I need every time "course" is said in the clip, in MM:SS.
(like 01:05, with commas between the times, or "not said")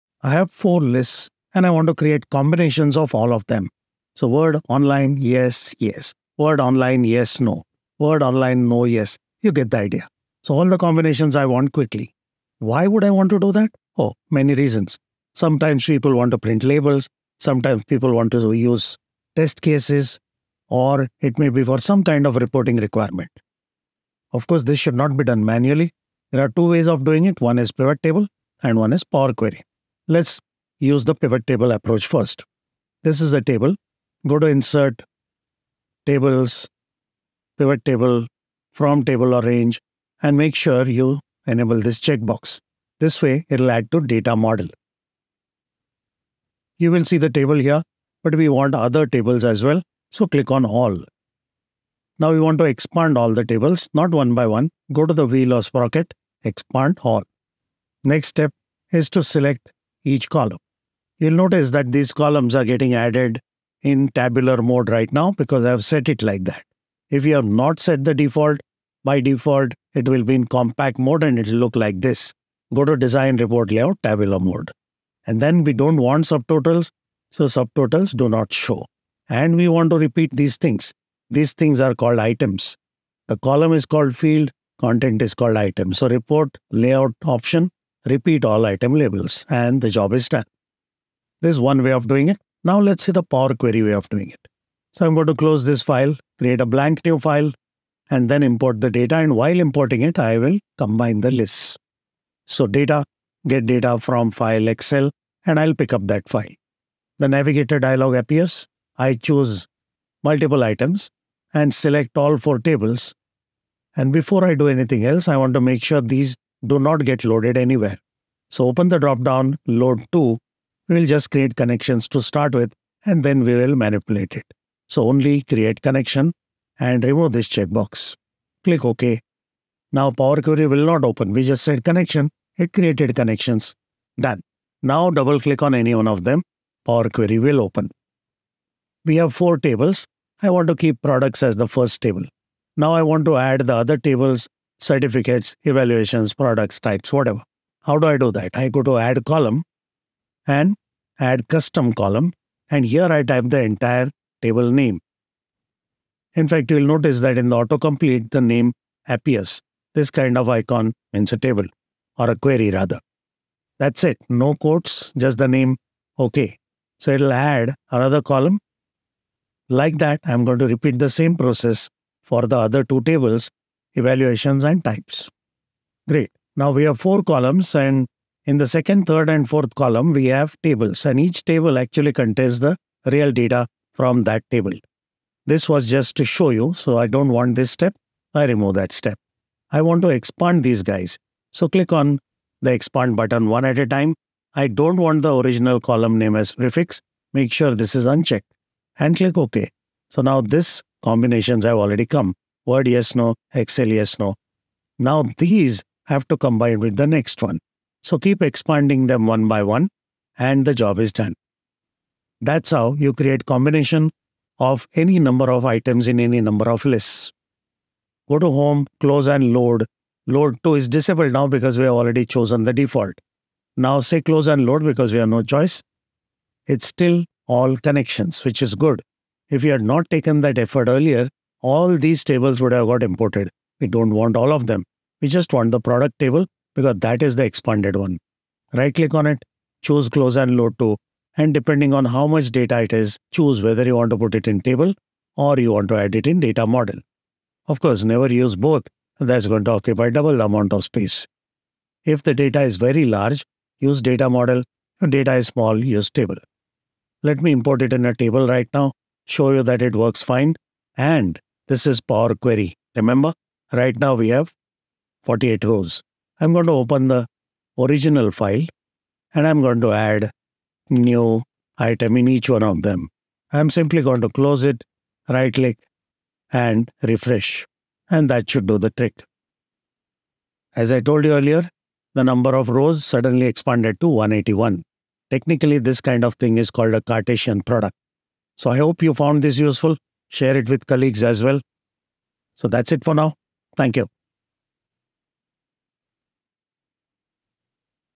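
00:24, 04:07.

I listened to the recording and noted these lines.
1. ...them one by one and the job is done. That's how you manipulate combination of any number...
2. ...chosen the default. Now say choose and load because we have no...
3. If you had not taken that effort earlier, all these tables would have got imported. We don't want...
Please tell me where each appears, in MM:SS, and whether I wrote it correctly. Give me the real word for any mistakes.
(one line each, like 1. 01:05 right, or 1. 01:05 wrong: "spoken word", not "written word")
1. 03:29 wrong: "create", not "manipulate"
2. 03:42 wrong: "close", not "choose"
3. 03:49 right.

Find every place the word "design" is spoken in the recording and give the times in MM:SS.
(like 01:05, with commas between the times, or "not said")
01:12.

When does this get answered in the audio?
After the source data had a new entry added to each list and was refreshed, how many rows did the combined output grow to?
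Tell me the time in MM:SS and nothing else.
04:44.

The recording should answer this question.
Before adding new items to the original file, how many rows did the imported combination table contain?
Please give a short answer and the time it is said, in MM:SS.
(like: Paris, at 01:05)
48, at 04:25.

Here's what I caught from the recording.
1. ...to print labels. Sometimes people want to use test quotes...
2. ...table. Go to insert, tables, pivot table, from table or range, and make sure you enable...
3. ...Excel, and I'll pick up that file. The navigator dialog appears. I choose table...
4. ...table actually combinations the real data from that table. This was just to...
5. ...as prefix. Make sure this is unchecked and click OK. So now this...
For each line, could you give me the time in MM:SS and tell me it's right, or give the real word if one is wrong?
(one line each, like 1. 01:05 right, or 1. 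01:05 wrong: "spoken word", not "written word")
1. 00:16 wrong: "cases", not "quotes"
2. 00:33 right
3. 01:44 wrong: "multiple", not "table"
4. 03:01 wrong: "contains", not "combinations"
5. 03:16 right.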